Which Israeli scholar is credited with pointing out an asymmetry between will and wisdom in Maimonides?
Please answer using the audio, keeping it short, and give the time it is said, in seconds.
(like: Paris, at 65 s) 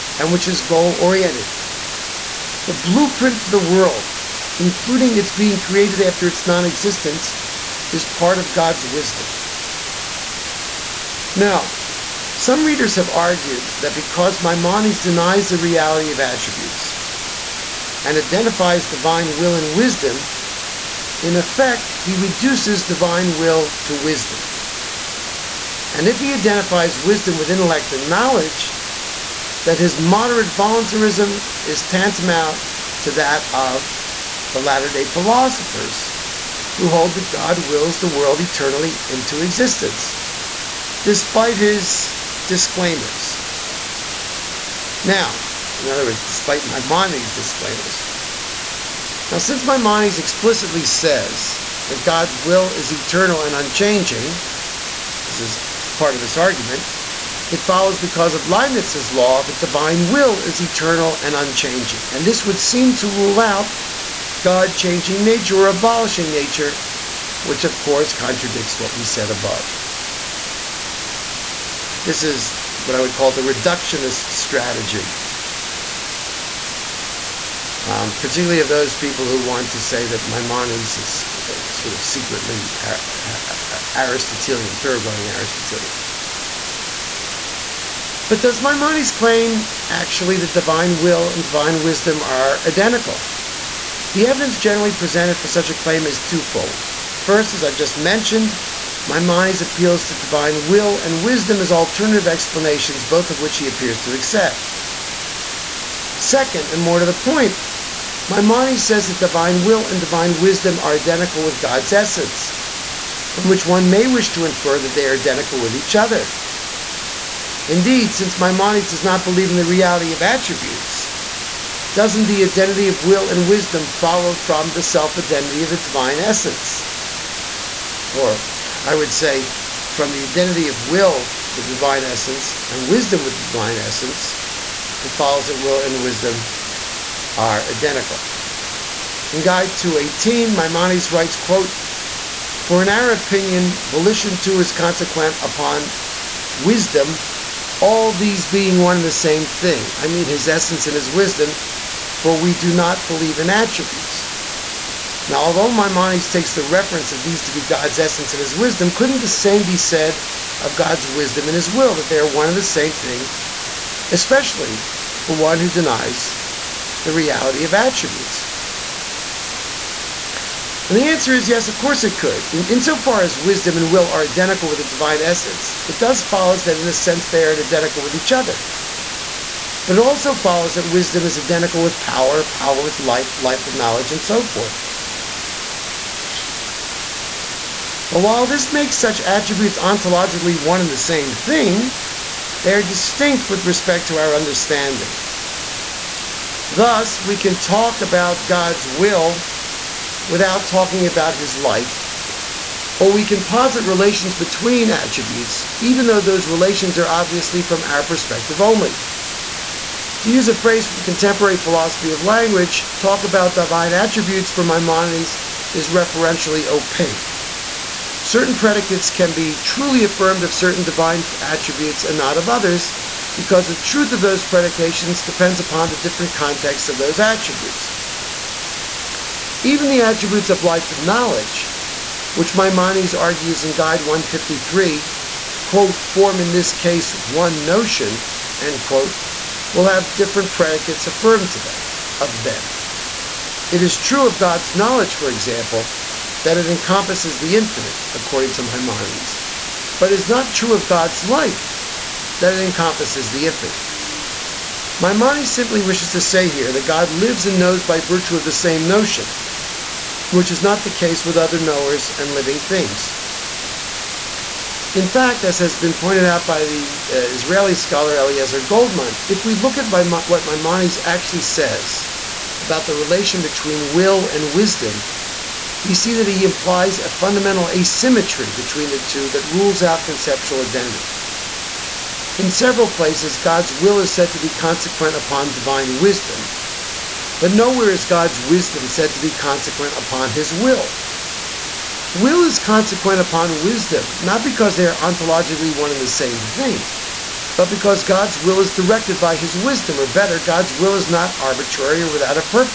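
Eliezer Goldman, at 268 s.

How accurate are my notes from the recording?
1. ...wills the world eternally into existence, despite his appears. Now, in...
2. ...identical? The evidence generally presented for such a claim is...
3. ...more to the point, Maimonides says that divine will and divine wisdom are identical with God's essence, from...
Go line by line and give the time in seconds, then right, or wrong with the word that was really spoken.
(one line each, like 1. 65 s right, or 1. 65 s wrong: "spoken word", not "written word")
1. 37 s wrong: "disclaimers", not "appears"
2. 92 s right
3. 106 s right.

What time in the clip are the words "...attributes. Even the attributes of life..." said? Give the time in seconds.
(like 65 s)
227 s.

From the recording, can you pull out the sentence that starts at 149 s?
I mean, his essence and his wisdom for we do not believe in attributes.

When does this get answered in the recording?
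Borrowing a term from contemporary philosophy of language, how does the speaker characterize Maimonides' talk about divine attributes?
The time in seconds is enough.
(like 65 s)
215 s.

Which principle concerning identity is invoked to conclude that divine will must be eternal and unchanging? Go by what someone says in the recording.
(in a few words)
Leibniz's law.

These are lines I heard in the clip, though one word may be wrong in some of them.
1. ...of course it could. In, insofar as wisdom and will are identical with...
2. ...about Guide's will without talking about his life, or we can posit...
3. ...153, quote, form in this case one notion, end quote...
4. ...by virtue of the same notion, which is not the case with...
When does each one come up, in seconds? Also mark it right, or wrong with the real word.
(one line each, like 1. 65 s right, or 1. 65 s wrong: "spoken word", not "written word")
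1. 171 s right
2. 198 s wrong: "God", not "Guide"
3. 234 s right
4. 257 s right.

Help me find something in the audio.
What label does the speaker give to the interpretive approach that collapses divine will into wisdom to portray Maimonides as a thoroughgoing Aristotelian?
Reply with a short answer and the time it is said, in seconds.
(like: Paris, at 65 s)
reductionist strategy, at 73 s.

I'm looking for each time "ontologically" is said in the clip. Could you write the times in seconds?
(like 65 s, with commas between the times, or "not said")
189 s, 294 s.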